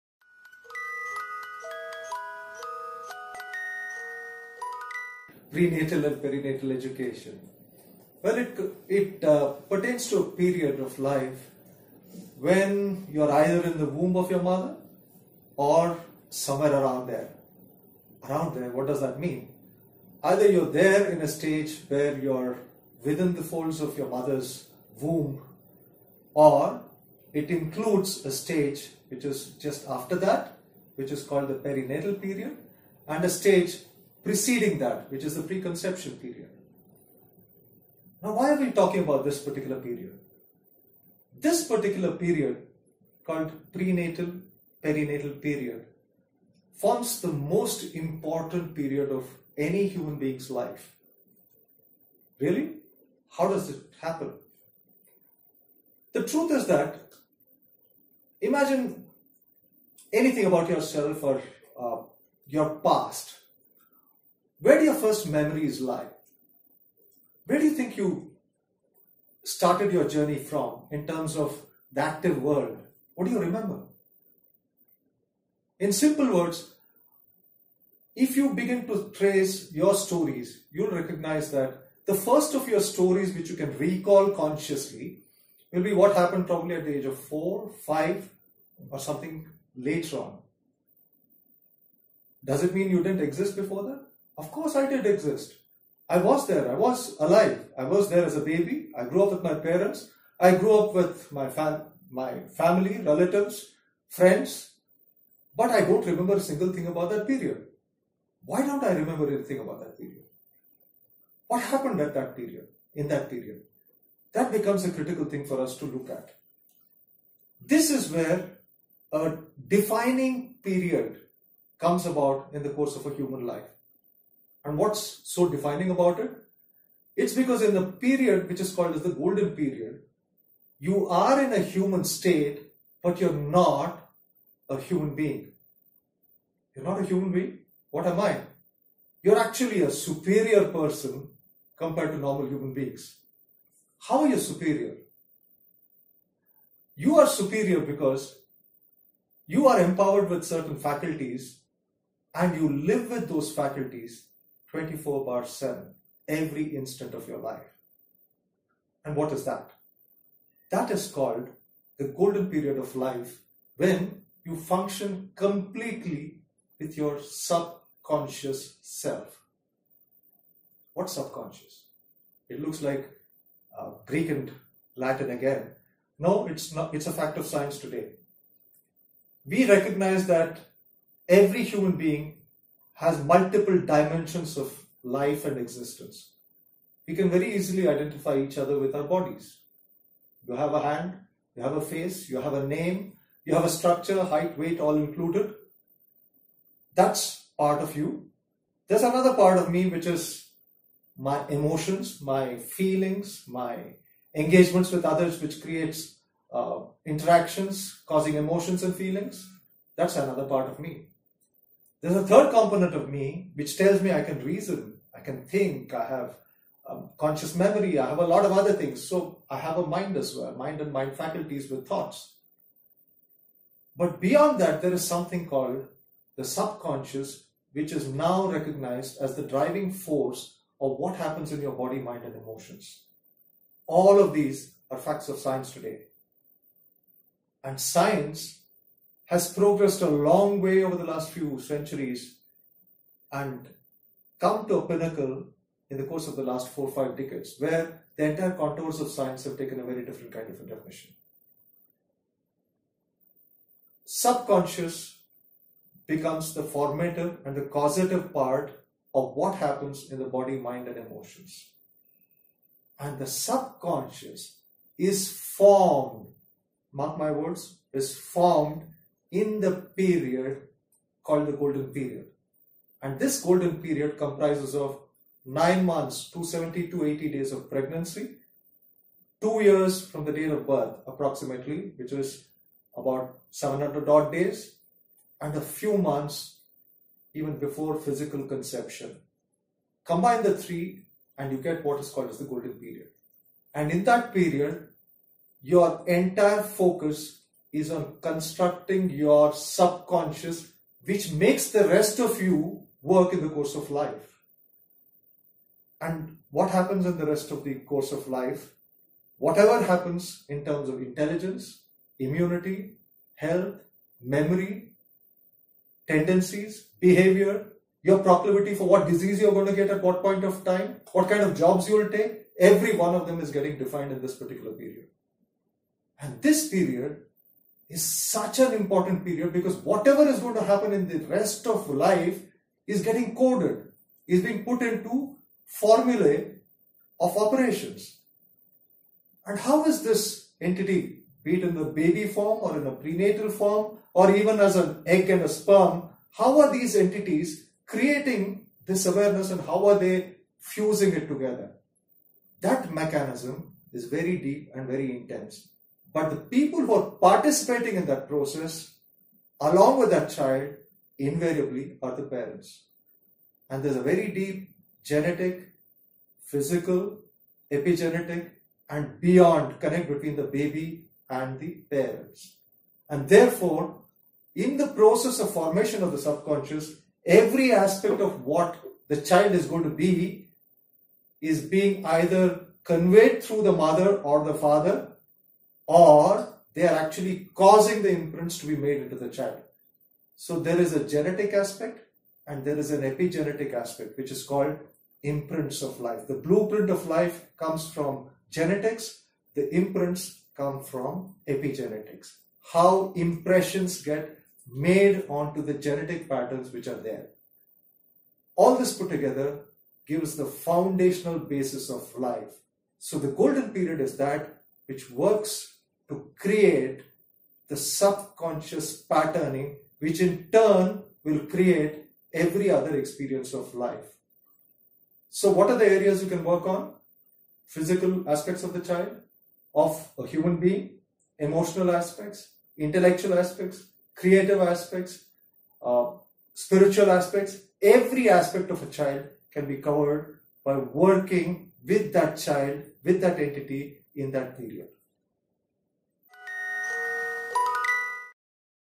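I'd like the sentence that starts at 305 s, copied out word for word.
And what happens in the rest of the course of life?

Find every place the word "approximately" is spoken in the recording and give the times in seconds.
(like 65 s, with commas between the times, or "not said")
281 s.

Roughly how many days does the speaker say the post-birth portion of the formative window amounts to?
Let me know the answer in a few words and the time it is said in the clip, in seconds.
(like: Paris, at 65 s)
about 700, at 283 s.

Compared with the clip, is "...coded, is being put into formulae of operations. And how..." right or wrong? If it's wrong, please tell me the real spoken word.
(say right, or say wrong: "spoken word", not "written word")
right.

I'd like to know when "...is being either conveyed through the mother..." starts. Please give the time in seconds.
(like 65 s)
381 s.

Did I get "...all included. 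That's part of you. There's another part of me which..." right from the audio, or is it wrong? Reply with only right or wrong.
right.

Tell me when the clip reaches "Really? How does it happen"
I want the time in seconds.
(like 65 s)
52 s.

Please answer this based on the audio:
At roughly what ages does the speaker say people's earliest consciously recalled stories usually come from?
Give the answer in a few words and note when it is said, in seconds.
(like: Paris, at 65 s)
4 or 5, at 87 s.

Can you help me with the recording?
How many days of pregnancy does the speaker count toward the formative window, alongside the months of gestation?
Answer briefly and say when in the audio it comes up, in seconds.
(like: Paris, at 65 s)
270 to 280 days, at 276 s.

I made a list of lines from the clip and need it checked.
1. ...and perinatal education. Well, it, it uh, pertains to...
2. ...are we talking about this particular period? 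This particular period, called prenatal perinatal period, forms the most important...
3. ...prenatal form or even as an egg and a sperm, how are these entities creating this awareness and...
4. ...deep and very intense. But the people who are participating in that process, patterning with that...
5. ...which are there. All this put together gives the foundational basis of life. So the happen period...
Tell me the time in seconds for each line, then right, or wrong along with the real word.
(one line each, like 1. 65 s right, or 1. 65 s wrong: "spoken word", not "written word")
1. 6 s right
2. 38 s right
3. 342 s right
4. 354 s wrong: "along", not "patterning"
5. 406 s wrong: "golden", not "happen".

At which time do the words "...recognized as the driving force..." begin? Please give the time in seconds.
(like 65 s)
228 s.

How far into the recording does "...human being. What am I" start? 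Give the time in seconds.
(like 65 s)
137 s.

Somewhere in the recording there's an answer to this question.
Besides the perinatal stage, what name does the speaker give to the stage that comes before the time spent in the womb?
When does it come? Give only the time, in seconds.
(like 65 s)
35 s.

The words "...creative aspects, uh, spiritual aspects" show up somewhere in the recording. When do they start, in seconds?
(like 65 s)
434 s.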